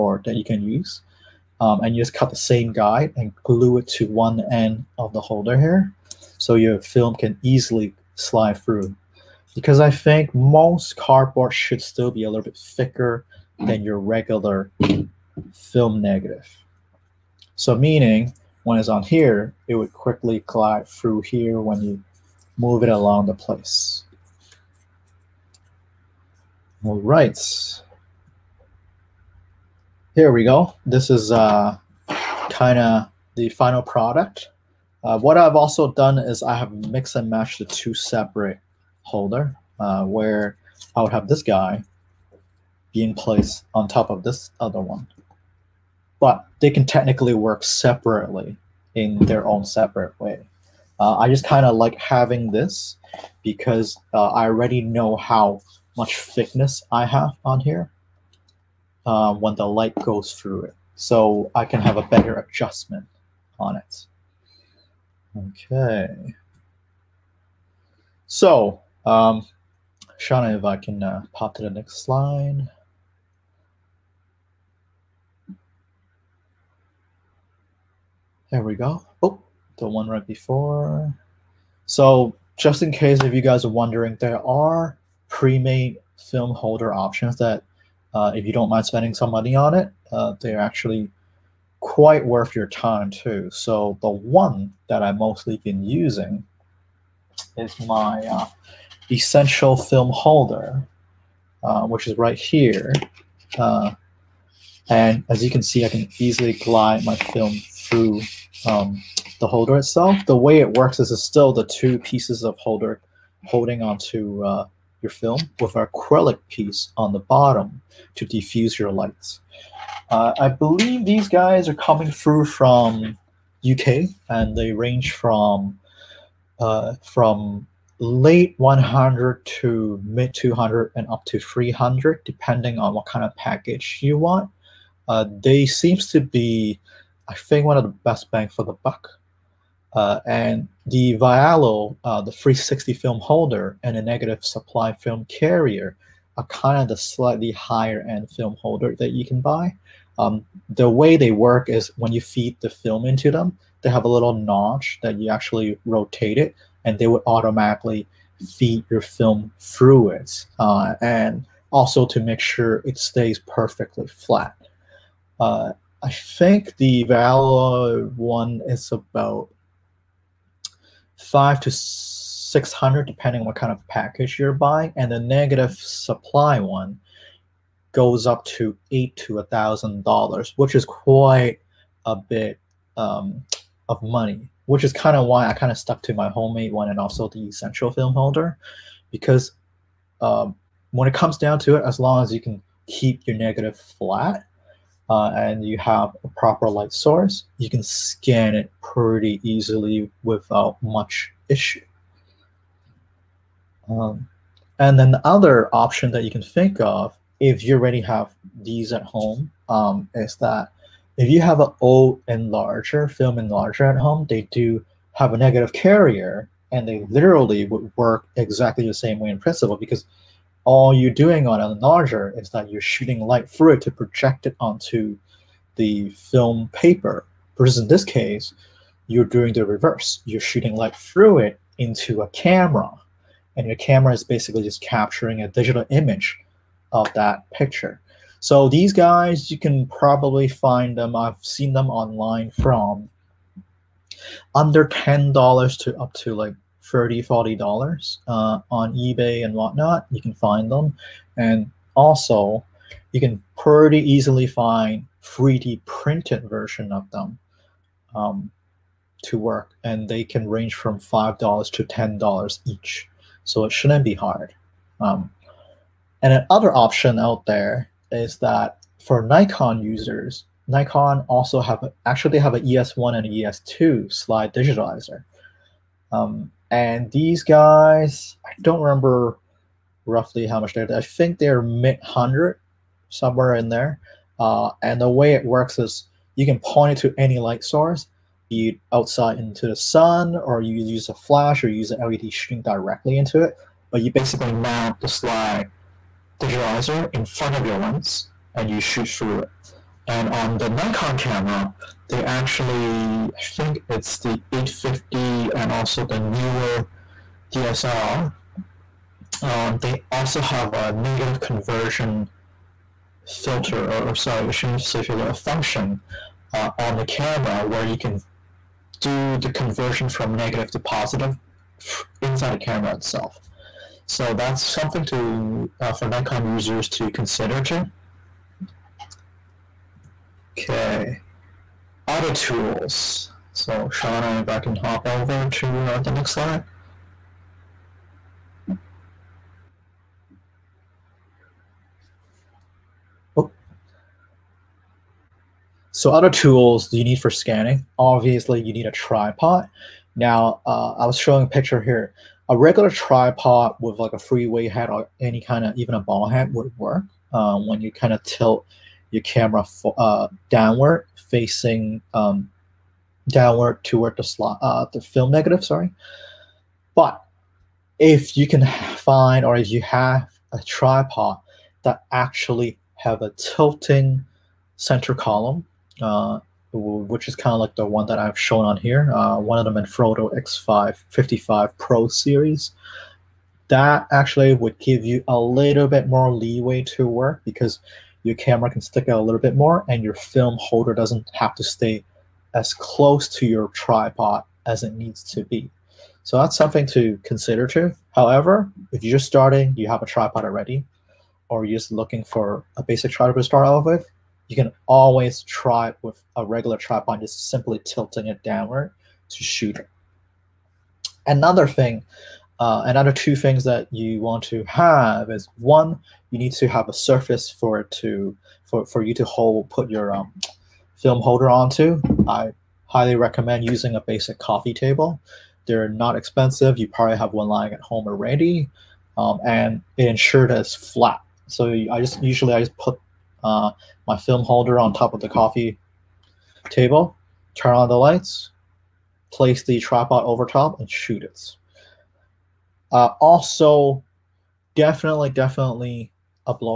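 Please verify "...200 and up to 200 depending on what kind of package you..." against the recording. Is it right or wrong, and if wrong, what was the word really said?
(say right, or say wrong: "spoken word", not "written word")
wrong: "300", not "200".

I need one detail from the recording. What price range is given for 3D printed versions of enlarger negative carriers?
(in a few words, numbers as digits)
$5 to $10.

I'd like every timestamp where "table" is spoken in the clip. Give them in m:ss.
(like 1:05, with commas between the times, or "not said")
7:04, 7:16.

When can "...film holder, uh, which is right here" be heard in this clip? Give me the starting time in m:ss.
1:39.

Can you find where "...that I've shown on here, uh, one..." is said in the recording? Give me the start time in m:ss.
6:18.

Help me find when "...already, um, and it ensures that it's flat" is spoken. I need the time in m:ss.
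7:08.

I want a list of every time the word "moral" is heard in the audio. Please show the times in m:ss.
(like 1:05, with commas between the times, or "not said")
not said.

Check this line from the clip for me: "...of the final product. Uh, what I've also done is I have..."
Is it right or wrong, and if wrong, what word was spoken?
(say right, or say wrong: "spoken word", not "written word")
right.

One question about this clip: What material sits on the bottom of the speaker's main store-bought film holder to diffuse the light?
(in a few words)
acrylic piece.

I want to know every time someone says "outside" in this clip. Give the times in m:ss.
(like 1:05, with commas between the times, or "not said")
4:48.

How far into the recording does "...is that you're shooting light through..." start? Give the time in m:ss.
3:42.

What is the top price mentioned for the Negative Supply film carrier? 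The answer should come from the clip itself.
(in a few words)
$1000.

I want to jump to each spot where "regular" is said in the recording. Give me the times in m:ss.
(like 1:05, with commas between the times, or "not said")
0:13, 5:52, 6:46.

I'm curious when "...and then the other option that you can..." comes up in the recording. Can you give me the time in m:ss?
3:24.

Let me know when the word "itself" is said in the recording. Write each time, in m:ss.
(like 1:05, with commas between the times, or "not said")
1:49, 5:22.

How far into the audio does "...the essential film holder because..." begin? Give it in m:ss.
3:07.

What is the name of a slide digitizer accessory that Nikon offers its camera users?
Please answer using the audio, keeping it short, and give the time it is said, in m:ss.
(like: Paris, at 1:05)
ES1, at 4:32.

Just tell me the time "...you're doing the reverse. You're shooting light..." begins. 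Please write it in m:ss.
3:49.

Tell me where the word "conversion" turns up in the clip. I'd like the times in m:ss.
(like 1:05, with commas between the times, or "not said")
5:11, 5:19.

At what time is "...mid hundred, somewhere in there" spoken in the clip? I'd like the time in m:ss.
4:41.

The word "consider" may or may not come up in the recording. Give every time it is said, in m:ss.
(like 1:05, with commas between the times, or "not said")
5:27, 6:37.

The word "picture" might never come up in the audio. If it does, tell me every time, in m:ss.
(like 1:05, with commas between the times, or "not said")
3:57, 5:51.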